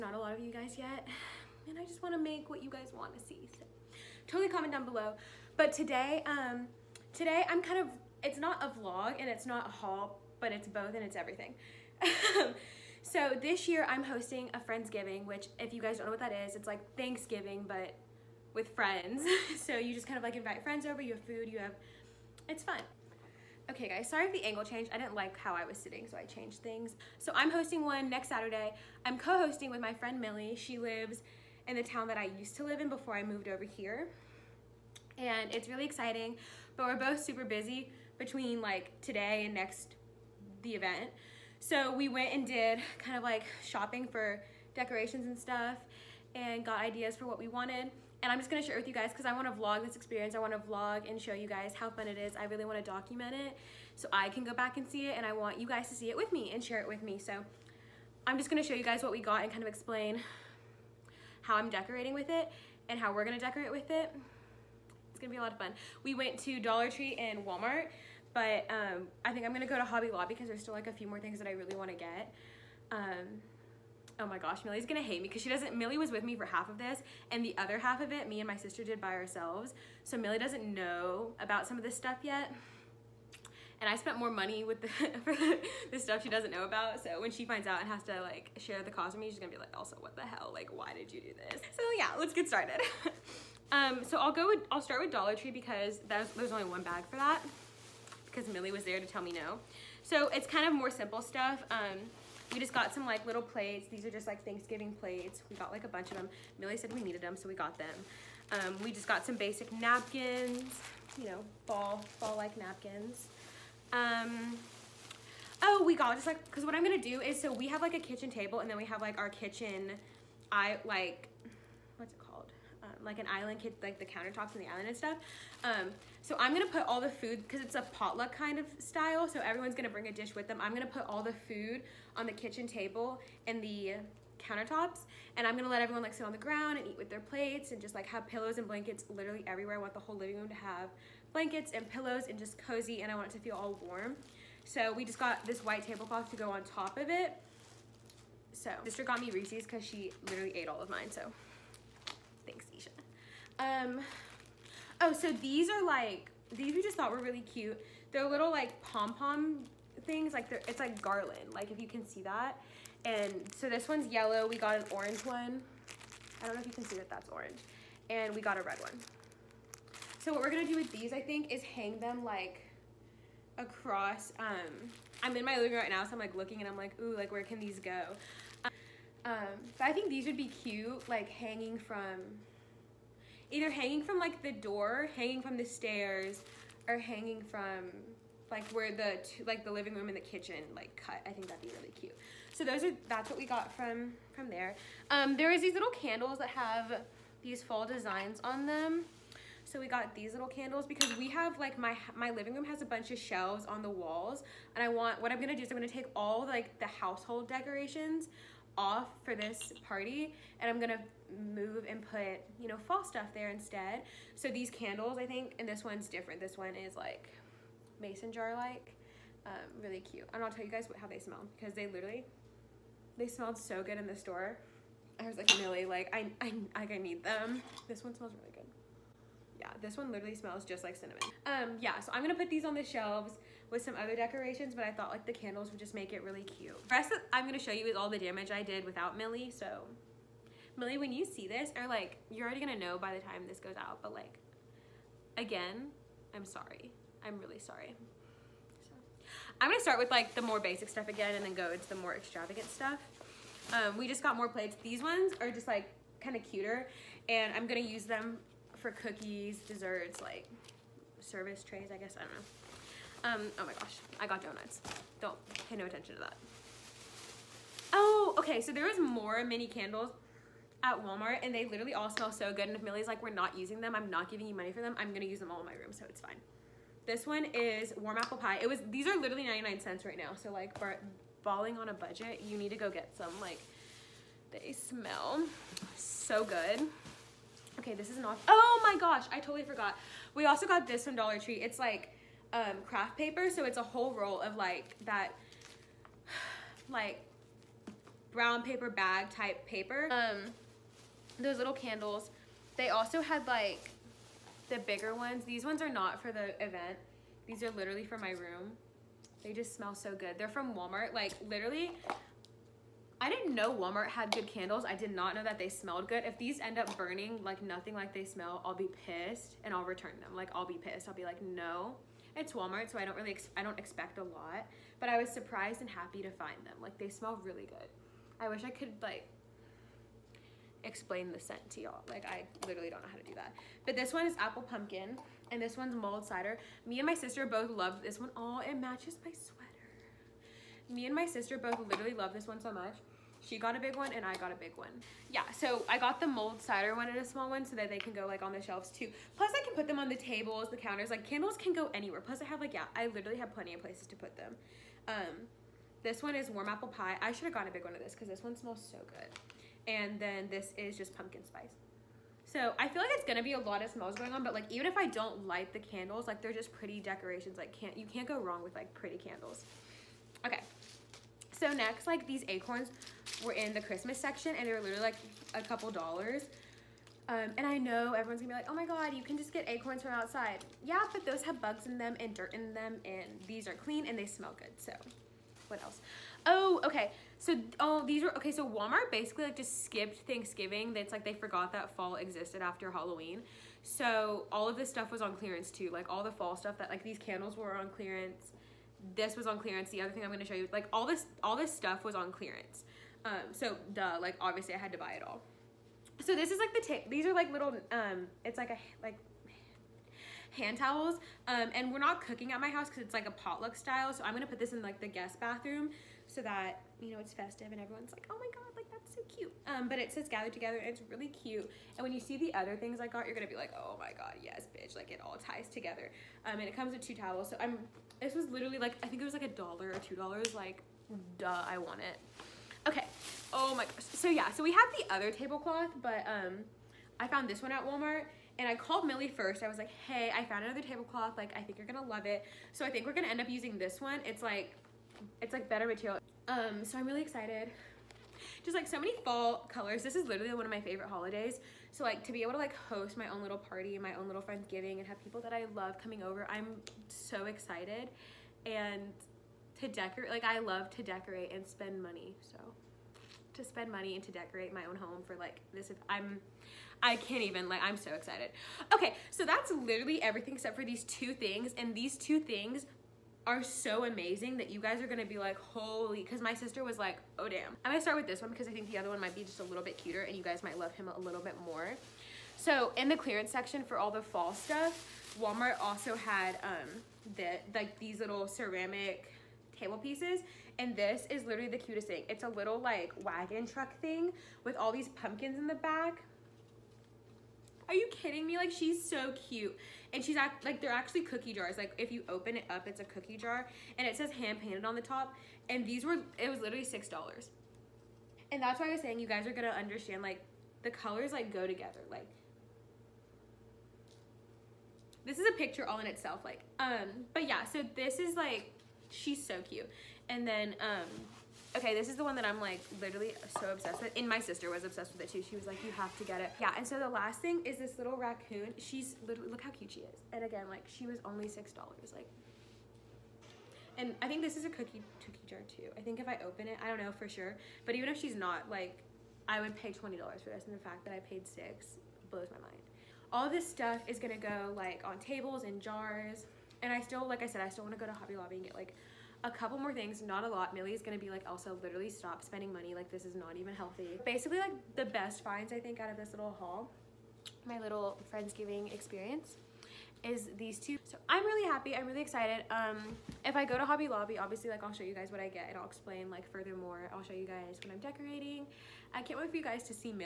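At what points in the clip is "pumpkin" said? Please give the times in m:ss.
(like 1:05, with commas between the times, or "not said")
5:34, 6:01, 8:15.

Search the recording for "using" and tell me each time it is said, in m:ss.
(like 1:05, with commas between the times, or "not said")
4:33, 7:23.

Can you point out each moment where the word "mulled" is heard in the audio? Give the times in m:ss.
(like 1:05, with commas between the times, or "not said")
5:35, 5:46.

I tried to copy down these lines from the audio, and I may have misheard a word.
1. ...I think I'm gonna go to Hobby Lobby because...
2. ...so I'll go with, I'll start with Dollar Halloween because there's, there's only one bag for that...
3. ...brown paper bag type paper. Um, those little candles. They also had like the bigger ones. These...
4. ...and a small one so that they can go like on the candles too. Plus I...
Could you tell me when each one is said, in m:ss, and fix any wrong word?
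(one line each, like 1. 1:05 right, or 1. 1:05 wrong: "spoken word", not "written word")
1. 1:09 right
2. 1:34 wrong: "Tree", not "Halloween"
3. 4:58 right
4. 5:47 wrong: "shelves", not "candles".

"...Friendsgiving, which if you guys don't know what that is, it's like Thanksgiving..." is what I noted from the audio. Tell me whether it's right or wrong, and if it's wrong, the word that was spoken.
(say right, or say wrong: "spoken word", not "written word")
right.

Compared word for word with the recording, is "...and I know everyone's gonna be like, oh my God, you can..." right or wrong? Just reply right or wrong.
right.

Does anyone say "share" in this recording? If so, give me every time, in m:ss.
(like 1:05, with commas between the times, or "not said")
0:48, 0:56, 1:28.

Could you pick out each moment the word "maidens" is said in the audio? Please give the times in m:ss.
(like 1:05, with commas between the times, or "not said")
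not said.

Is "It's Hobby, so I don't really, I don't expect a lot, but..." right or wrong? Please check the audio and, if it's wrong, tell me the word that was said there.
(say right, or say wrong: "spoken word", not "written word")
wrong: "Walmart", not "Hobby".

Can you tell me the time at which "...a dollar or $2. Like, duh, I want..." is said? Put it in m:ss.
7:09.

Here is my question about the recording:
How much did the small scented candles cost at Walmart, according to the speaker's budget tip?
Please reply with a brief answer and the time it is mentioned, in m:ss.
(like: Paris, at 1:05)
99 cents, at 4:39.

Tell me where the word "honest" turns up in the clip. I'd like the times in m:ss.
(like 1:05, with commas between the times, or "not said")
not said.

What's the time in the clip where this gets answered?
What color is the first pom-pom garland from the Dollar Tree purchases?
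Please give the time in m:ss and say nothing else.
2:44.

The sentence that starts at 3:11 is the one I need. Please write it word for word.
I think that'd be really cute.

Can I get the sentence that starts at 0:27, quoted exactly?
So I'm hosting one next Saturday.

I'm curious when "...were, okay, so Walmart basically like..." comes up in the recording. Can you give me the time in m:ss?
6:28.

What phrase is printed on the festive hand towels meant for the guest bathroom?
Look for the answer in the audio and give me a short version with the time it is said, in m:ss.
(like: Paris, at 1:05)
Gathered together, at 7:00.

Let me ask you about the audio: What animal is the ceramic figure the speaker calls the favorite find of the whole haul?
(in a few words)
Raccoon.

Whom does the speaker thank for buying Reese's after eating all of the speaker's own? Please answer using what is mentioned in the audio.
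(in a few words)
Isha.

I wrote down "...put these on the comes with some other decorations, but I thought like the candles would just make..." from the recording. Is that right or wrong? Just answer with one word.
wrong.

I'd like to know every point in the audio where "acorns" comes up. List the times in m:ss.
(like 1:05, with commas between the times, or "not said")
6:12, 6:19.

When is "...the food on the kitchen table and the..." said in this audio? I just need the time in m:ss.
2:11.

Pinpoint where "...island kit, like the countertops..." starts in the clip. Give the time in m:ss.
2:03.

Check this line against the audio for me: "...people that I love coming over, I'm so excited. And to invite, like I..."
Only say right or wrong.
wrong.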